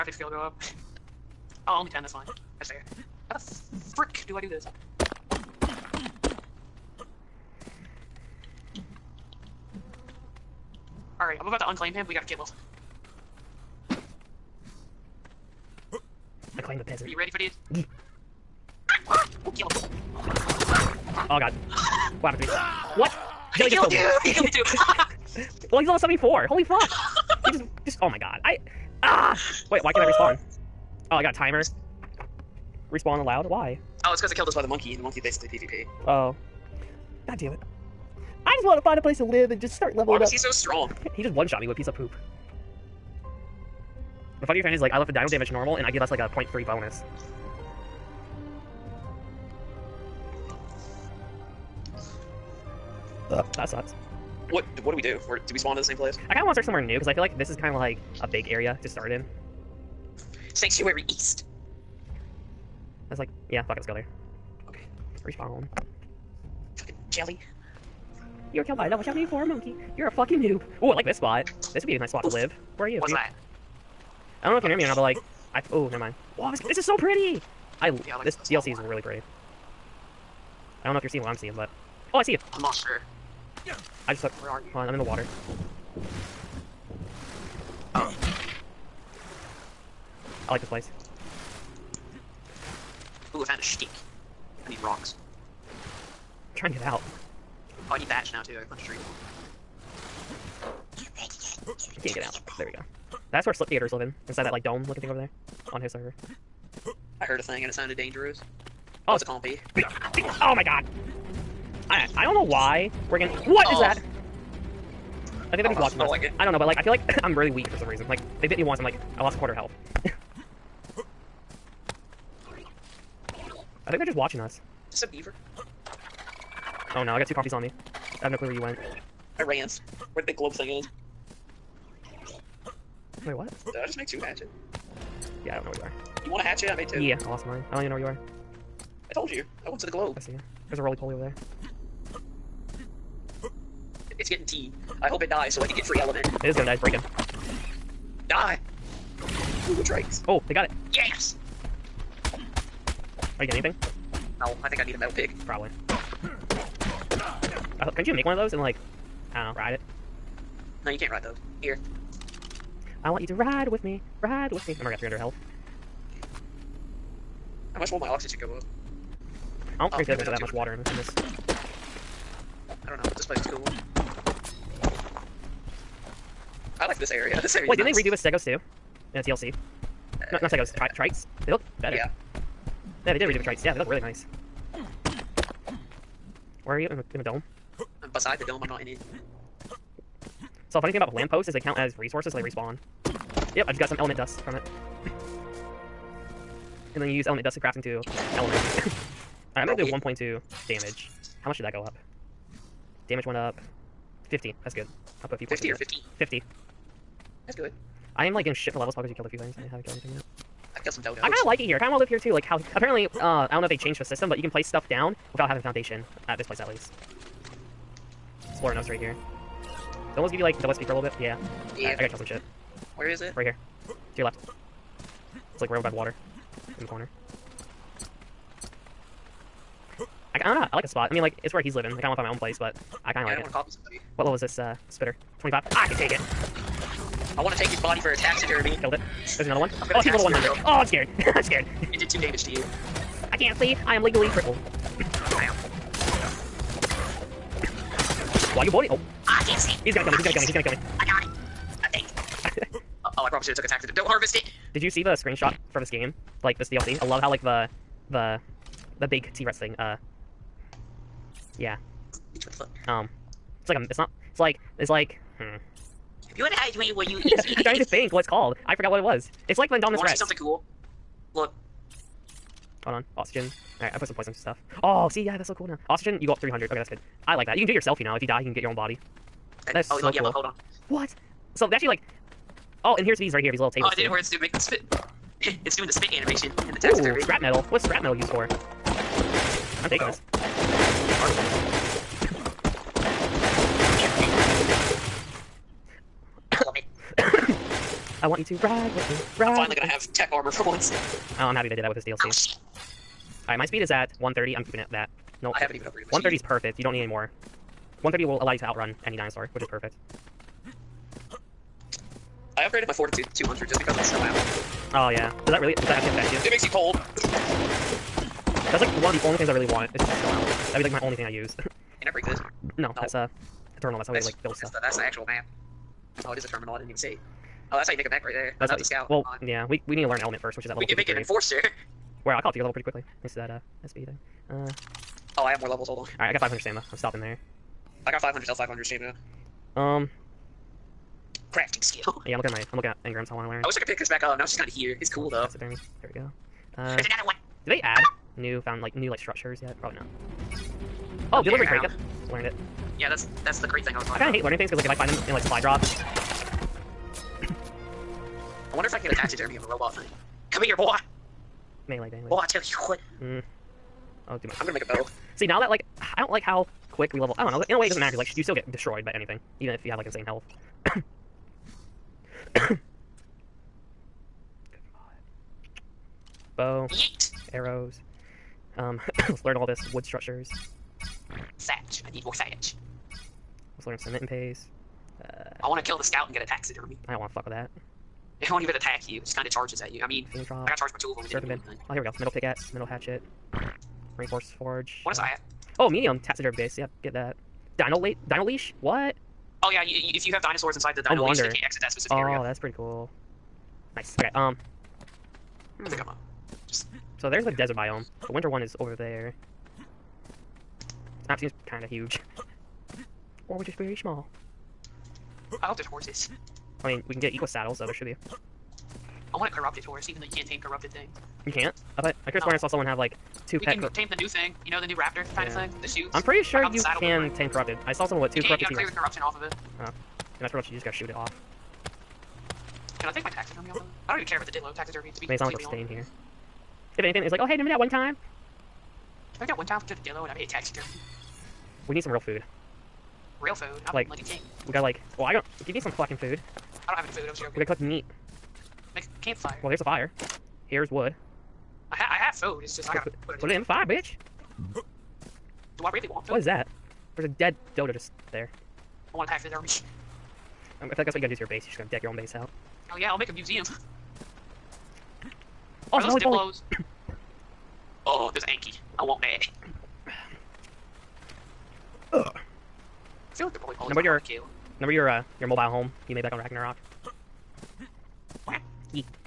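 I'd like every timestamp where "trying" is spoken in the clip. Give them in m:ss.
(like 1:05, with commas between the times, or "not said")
1:36, 4:27.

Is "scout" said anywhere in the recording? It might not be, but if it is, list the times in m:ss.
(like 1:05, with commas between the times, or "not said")
5:28, 6:26.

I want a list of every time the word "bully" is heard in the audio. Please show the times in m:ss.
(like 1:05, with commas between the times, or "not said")
4:08.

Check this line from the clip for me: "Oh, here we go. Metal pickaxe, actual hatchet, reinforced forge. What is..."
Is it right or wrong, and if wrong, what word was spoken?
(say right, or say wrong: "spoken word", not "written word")
wrong: "metal", not "actual".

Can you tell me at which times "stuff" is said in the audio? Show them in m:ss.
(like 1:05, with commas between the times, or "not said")
3:34, 4:34, 5:24.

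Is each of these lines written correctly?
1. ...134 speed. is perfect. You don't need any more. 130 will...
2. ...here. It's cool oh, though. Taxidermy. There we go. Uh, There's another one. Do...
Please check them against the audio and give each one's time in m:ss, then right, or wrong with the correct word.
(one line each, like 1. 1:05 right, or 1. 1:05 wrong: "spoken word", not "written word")
1. 5:06 wrong: "130", not "134"
2. 5:44 right.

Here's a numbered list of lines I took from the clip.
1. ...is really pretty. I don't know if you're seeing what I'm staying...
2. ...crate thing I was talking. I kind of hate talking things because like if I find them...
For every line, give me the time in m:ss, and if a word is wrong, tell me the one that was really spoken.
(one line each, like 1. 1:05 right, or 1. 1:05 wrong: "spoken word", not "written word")
1. 1:18 wrong: "seeing", not "staying"
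2. 5:53 wrong: "learning", not "talking".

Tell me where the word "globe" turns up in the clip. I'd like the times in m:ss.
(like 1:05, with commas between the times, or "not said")
2:10, 2:19.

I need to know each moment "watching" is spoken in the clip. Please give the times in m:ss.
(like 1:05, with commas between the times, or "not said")
1:55, 2:04.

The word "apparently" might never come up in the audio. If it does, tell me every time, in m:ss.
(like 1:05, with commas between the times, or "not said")
3:32.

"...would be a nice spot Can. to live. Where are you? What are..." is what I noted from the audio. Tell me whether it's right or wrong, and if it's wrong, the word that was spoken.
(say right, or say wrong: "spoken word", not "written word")
wrong: "Oof", not "Can".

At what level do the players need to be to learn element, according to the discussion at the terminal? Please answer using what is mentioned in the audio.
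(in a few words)
53.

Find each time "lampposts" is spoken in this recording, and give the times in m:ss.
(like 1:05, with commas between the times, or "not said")
3:11.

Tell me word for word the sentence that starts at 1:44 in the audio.
Inside that like dome looking thing over there.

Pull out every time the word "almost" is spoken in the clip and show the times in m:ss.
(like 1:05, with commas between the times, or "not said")
0:25.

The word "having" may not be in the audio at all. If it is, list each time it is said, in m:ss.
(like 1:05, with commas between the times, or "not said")
3:35.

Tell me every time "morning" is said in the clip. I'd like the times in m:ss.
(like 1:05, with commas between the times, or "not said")
not said.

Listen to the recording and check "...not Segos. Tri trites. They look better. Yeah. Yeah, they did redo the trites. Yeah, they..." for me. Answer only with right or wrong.
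right.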